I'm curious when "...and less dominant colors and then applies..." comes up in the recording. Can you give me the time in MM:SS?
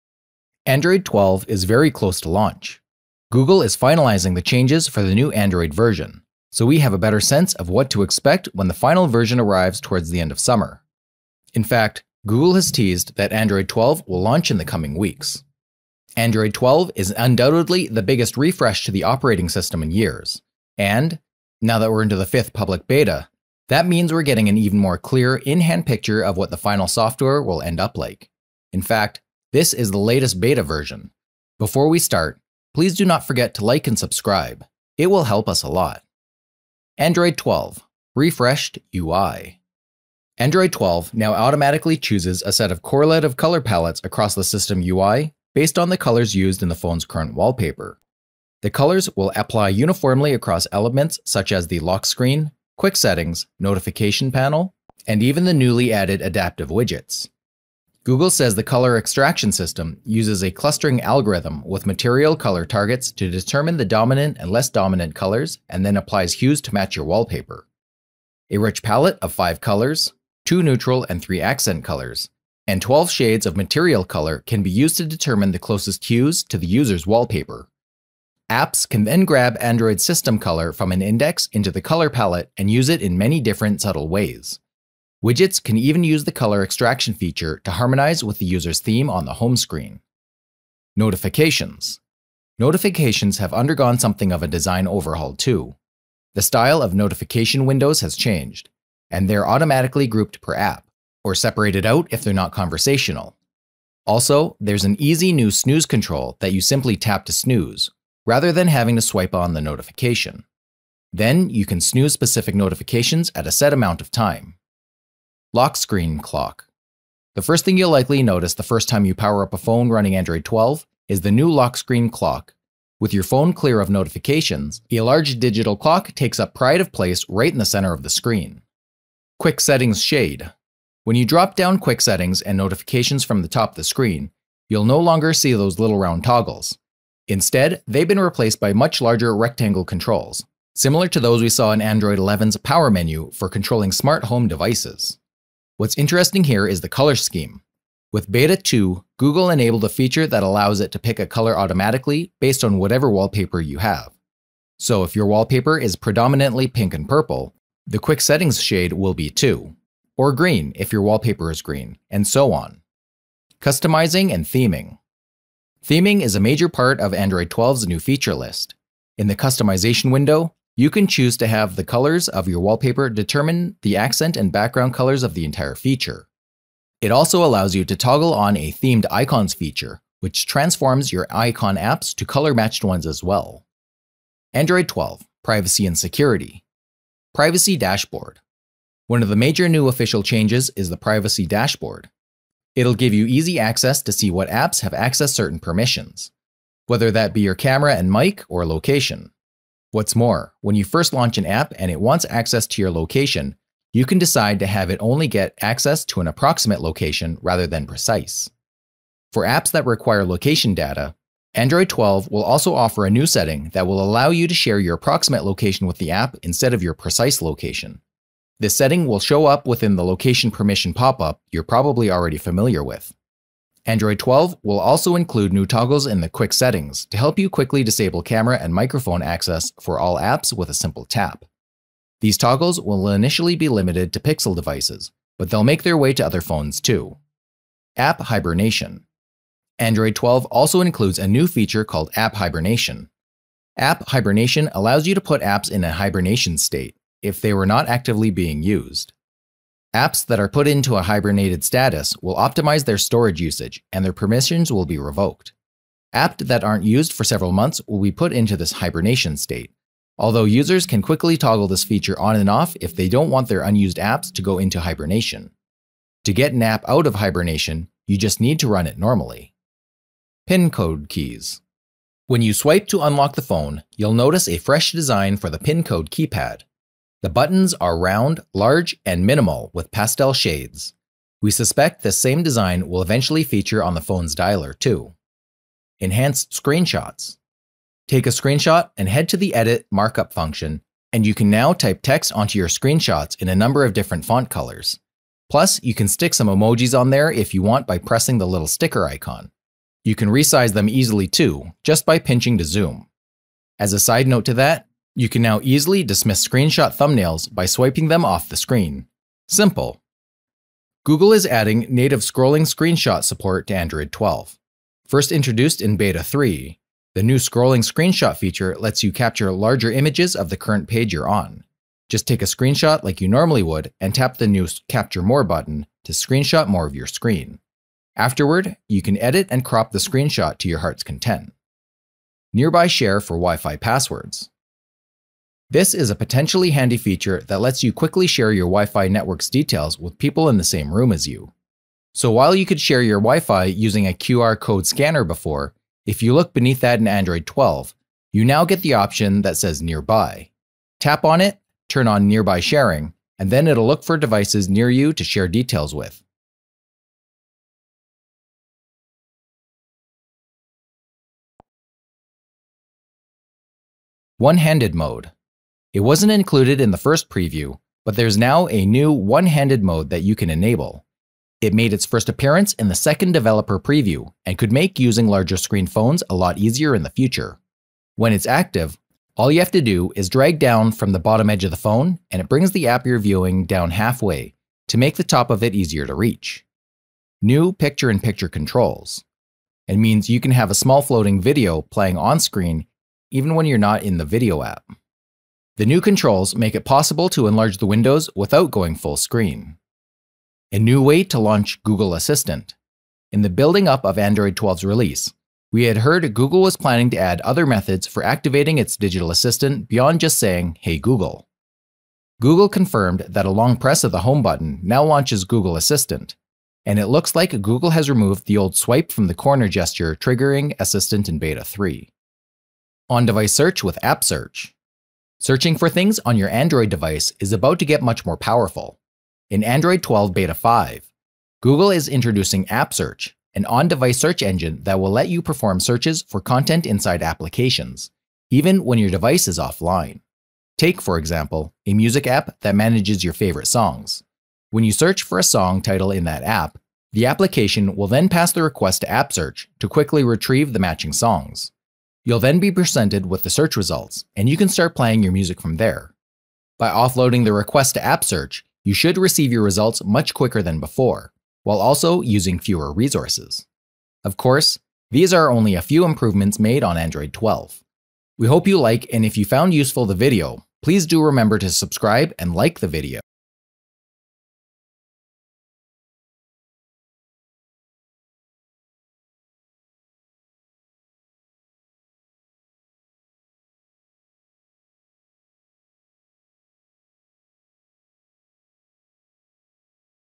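01:04.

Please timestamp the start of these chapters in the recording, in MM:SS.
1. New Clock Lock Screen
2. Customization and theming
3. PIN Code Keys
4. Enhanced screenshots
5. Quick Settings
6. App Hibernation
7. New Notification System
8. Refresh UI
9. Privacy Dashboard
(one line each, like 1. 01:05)
1. 01:54
2. 02:43
3. 04:29
4. 04:45
5. 02:09
6. 03:57
7. 01:30
8. 00:36
9. 03:03.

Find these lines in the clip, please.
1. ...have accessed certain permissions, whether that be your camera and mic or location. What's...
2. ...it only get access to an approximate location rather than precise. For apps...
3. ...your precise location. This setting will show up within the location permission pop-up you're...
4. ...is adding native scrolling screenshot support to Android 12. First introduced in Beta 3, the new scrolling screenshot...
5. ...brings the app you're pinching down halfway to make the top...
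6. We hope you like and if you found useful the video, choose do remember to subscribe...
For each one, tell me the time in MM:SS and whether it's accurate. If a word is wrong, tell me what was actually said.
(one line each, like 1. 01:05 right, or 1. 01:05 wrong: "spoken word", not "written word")
1. 03:14 right
2. 03:24 right
3. 03:36 right
4. 05:11 right
5. 06:22 wrong: "viewing", not "pinching"
6. 07:48 wrong: "please", not "choose".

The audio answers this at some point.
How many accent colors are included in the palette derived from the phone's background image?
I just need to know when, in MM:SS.
01:11.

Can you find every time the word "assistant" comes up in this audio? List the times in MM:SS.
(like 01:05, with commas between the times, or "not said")
06:42, 06:49, 06:55, 07:00.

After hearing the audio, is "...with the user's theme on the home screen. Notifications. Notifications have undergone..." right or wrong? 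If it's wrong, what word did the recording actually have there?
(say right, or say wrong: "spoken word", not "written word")
right.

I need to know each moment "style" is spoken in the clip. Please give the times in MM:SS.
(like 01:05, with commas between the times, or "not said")
01:36.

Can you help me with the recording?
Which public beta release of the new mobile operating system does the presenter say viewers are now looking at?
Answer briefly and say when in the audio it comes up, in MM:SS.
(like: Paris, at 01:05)
fifth, at 00:22.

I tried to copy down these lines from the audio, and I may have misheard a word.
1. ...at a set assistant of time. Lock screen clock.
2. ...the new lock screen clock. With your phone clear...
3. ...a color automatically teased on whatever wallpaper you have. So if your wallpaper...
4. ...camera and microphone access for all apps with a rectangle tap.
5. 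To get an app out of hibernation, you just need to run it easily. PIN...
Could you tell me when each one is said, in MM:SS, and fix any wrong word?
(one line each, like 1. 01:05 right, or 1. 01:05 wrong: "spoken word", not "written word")
1. 01:53 wrong: "amount", not "assistant"
2. 02:01 right
3. 02:31 wrong: "based", not "teased"
4. 03:48 wrong: "simple", not "rectangle"
5. 04:26 wrong: "normally", not "easily".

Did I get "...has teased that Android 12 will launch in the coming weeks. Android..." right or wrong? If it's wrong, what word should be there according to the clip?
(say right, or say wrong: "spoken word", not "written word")
right.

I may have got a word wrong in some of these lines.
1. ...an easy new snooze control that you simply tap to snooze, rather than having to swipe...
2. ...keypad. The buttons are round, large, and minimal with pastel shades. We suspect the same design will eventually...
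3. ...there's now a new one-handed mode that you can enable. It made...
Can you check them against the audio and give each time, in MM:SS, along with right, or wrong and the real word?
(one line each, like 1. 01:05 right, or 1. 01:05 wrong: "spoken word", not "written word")
1. 01:44 right
2. 04:36 right
3. 06:08 right.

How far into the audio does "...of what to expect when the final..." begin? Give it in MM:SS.
00:07.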